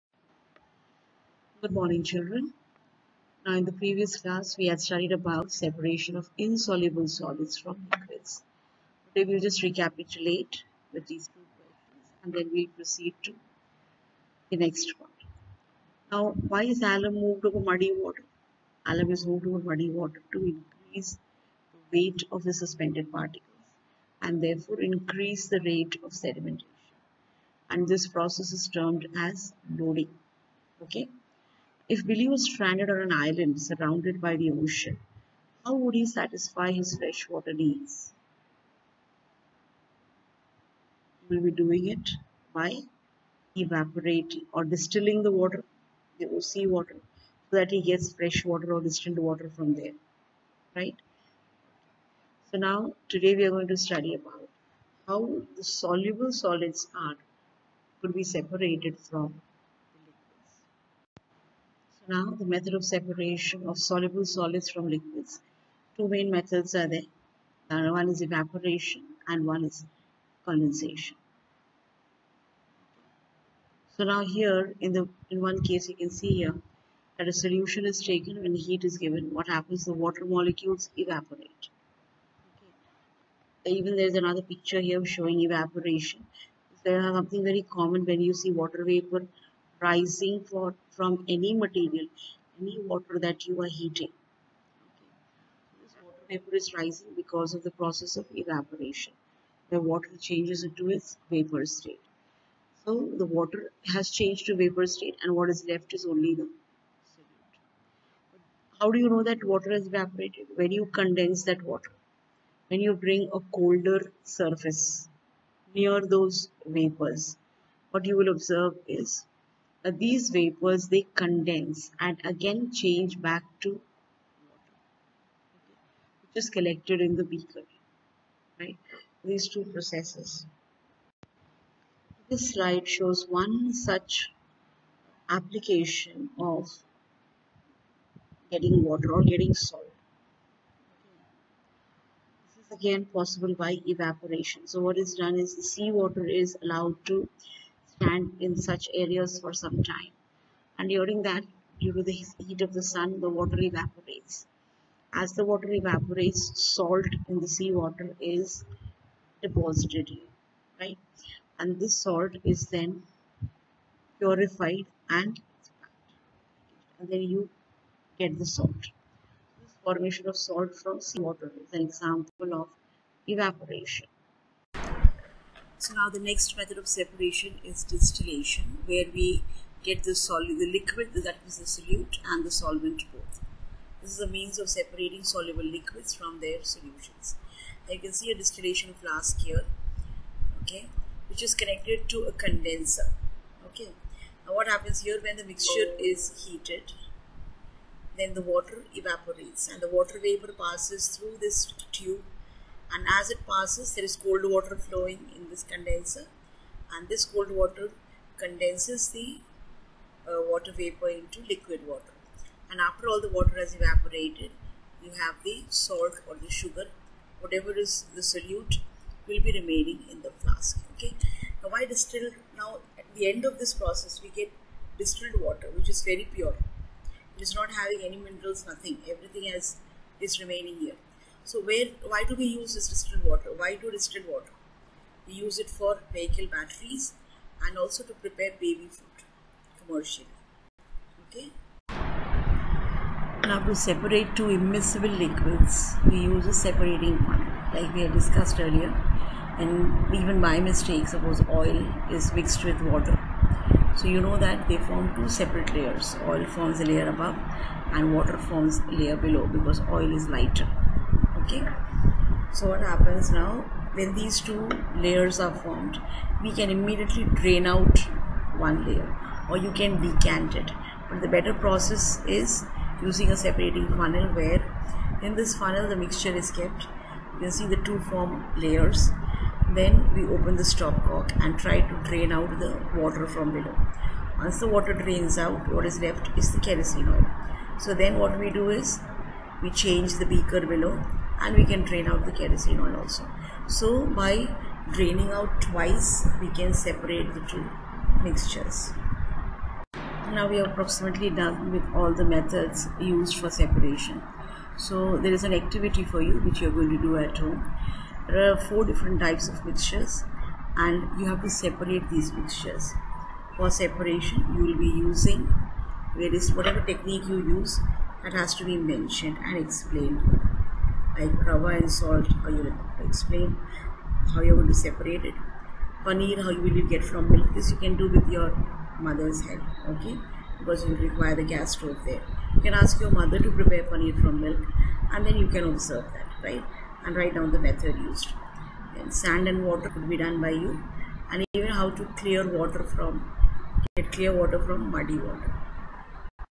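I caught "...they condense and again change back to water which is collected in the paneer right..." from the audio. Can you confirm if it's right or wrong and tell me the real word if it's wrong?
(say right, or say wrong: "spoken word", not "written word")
wrong: "beaker", not "paneer".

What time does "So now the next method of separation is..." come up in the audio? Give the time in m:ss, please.
2:55.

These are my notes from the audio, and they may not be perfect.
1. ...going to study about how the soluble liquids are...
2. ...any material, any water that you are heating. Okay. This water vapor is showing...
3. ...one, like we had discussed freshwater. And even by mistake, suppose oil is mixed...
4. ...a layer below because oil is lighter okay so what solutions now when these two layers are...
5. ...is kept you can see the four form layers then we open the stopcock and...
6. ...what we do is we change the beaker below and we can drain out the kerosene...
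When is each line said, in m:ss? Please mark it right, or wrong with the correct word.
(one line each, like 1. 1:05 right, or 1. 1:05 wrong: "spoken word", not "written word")
1. 0:53 wrong: "solids", not "liquids"
2. 1:31 wrong: "rising", not "showing"
3. 4:07 wrong: "earlier", not "freshwater"
4. 4:18 wrong: "happens", not "solutions"
5. 4:36 wrong: "two", not "four"
6. 4:48 right.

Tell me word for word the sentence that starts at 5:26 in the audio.
Paneer, how you will get from milk.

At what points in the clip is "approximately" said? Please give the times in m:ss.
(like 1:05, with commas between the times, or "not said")
5:00.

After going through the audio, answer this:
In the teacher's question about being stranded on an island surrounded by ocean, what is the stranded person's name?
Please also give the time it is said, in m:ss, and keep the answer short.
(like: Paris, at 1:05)
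Billy, at 0:32.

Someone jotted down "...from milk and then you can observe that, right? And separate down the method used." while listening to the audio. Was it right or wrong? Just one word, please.
wrong.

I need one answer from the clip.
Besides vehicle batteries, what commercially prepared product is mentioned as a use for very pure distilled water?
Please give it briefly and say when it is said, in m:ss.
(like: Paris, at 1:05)
baby food, at 3:58.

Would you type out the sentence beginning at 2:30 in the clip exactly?
And during that, due to the heat of the sun, the water evaporates.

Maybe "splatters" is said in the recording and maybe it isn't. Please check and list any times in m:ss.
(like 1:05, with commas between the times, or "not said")
not said.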